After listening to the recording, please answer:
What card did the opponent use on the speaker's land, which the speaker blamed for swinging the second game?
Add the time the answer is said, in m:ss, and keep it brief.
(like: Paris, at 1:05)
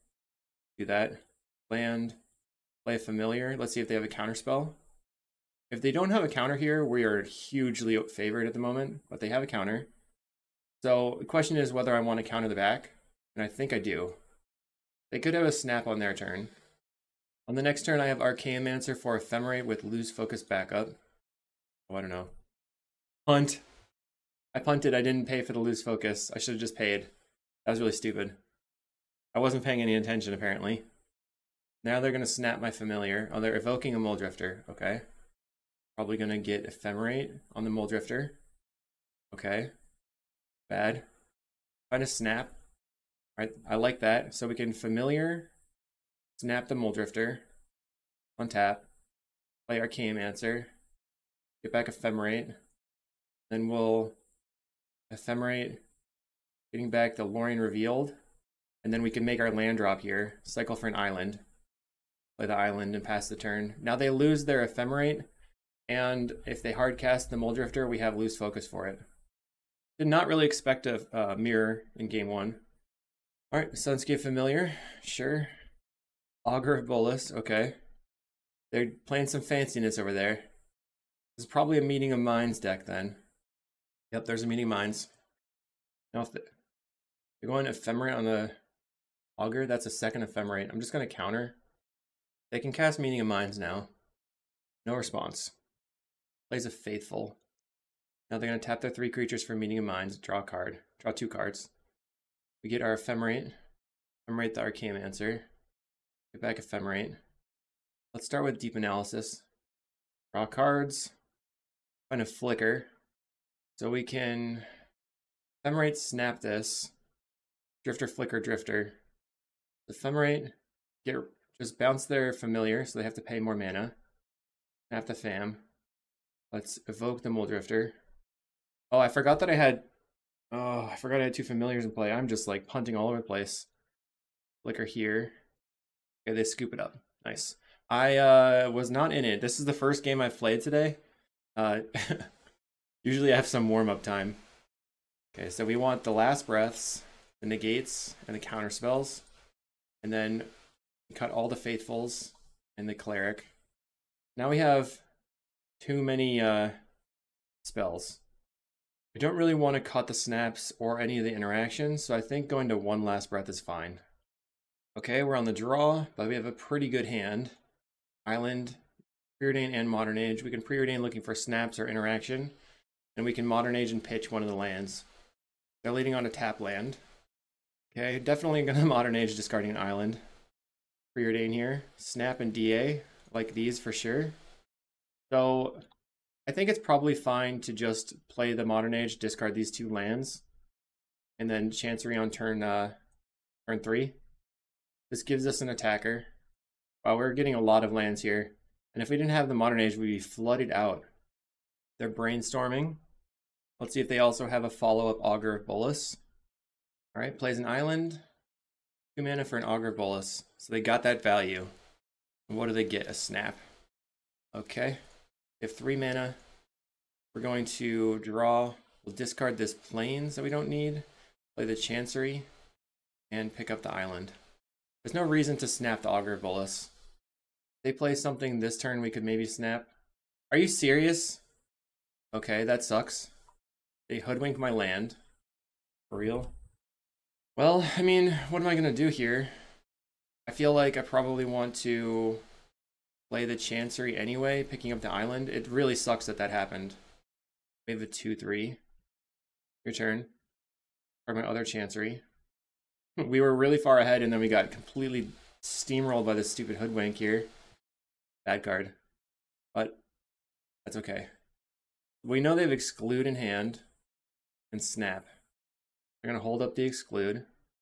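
Hoodwink, at 3:54.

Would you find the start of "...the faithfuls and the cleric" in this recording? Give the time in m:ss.
2:31.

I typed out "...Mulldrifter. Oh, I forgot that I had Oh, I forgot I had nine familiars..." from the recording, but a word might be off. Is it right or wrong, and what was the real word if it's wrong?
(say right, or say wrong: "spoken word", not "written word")
wrong: "two", not "nine".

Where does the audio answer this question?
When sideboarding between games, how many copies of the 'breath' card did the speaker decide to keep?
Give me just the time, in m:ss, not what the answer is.
2:42.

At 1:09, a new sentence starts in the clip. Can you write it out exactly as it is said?
Did not really expect a uh, mirror in game one.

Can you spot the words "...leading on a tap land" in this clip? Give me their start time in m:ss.
2:55.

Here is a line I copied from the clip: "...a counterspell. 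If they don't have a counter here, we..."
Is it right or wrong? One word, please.
right.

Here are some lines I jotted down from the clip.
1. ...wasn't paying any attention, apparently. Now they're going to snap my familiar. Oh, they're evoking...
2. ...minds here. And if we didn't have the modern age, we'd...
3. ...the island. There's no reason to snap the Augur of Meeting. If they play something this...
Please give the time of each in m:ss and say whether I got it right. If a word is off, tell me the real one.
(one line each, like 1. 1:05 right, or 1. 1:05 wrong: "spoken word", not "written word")
1. 0:29 right
2. 3:17 wrong: "lands", not "minds"
3. 3:43 wrong: "Bolas", not "Meeting".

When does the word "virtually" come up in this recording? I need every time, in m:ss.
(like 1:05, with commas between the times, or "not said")
not said.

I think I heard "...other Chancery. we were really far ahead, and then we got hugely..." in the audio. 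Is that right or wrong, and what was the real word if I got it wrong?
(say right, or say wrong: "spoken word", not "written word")
wrong: "completely", not "hugely".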